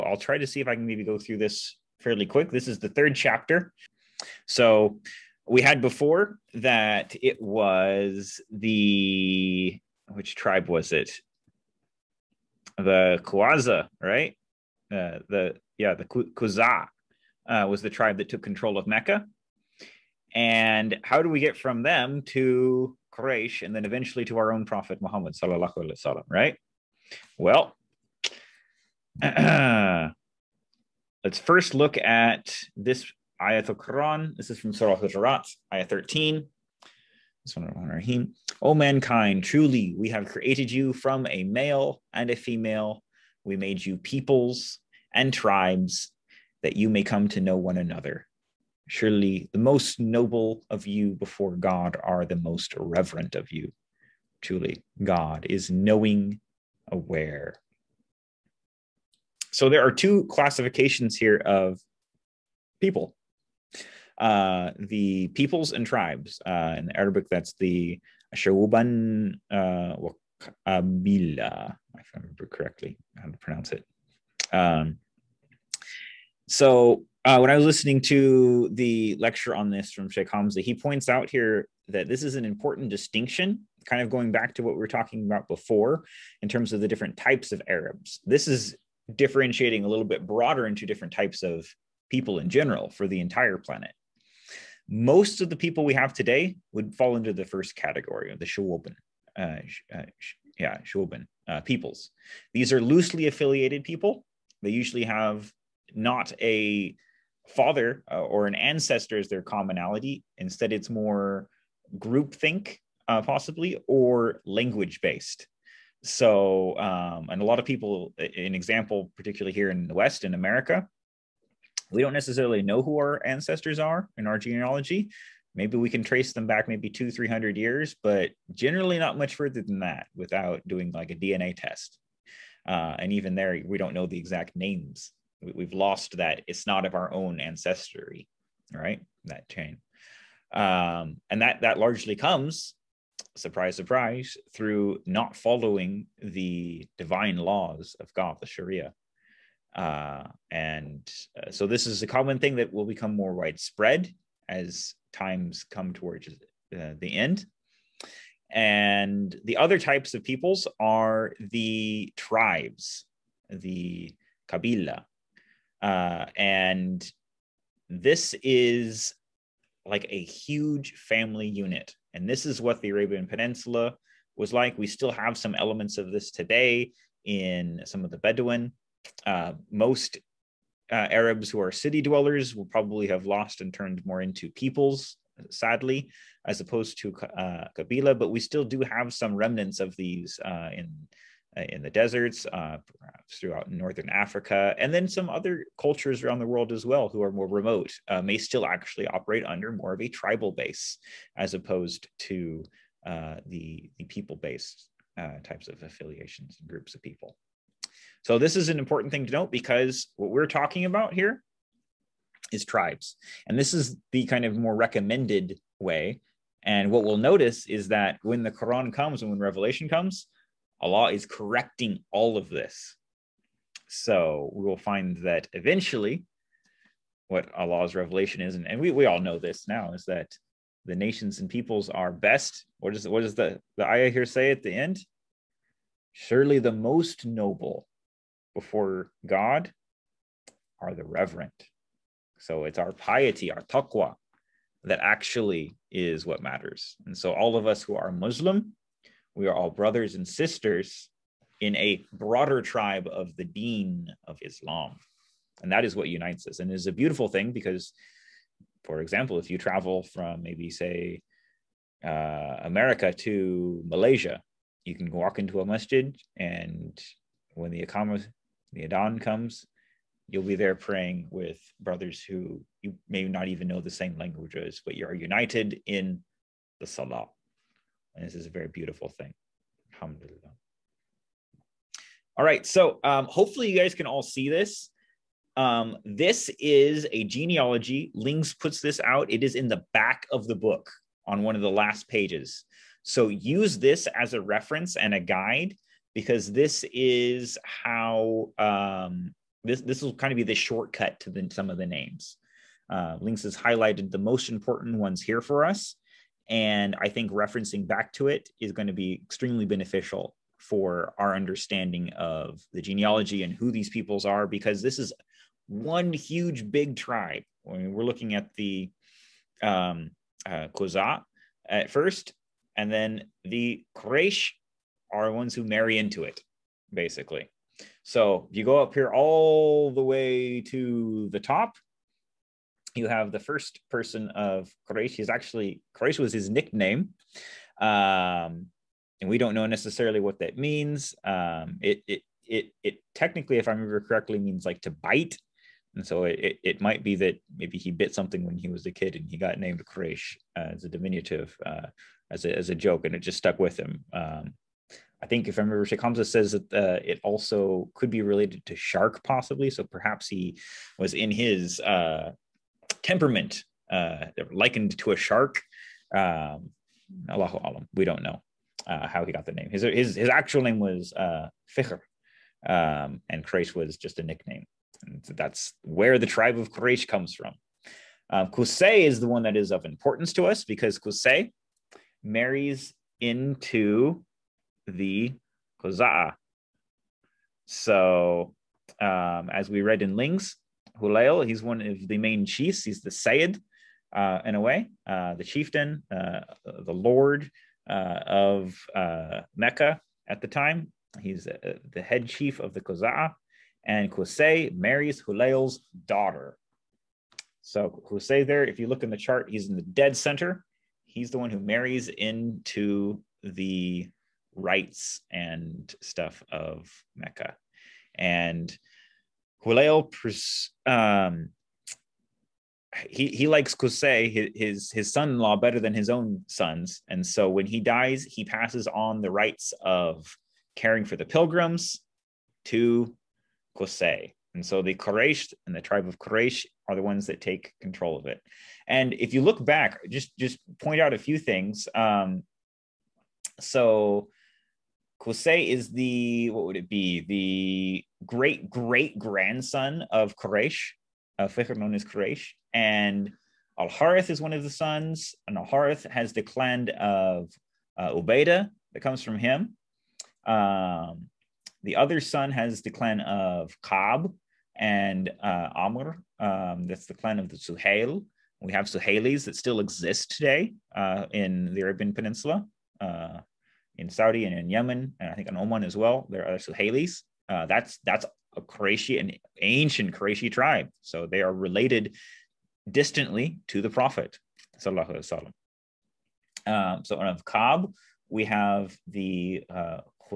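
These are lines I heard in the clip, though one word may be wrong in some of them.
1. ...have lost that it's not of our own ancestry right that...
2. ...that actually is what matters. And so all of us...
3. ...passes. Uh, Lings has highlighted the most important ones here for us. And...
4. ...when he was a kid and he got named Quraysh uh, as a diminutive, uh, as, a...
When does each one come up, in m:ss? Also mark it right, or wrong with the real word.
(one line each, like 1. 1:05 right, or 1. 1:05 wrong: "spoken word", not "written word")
1. 2:15 right
2. 4:04 right
3. 5:01 wrong: "names", not "passes"
4. 5:48 right.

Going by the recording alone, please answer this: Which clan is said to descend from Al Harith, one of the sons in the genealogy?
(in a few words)
Ubaidah.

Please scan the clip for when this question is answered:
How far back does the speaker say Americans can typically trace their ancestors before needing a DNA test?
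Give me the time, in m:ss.
2:06.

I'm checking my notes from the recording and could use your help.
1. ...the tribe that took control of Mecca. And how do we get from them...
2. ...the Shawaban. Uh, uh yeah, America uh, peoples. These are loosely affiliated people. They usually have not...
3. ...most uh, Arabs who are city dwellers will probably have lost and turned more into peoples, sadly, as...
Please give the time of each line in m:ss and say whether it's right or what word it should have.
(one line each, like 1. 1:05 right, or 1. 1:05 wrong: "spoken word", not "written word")
1. 0:17 right
2. 1:38 wrong: "Shawaban", not "America"
3. 2:59 right.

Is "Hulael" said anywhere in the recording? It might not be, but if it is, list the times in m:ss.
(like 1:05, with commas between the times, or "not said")
6:31, 6:45, 6:59.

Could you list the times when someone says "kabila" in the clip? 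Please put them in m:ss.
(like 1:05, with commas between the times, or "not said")
2:44, 3:07.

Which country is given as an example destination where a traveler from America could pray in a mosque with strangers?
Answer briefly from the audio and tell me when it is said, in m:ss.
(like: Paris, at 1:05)
Malaysia, at 4:23.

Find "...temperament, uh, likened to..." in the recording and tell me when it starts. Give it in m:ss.
6:03.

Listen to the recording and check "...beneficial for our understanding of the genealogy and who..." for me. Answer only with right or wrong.
right.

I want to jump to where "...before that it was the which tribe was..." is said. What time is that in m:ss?
0:05.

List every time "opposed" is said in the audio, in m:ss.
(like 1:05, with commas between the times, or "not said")
3:06, 3:21.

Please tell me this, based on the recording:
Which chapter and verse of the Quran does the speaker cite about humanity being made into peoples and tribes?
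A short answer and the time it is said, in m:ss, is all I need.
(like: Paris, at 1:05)
Al-Hujurat 13, at 0:34.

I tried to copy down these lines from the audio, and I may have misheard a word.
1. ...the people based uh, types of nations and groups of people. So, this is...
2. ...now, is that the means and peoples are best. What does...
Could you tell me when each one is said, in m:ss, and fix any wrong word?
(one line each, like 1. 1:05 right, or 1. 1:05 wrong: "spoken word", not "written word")
1. 3:23 wrong: "affiliations", not "nations"
2. 3:49 wrong: "nations", not "means".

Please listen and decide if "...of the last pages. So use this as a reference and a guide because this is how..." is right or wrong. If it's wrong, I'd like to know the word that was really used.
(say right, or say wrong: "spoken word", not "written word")
right.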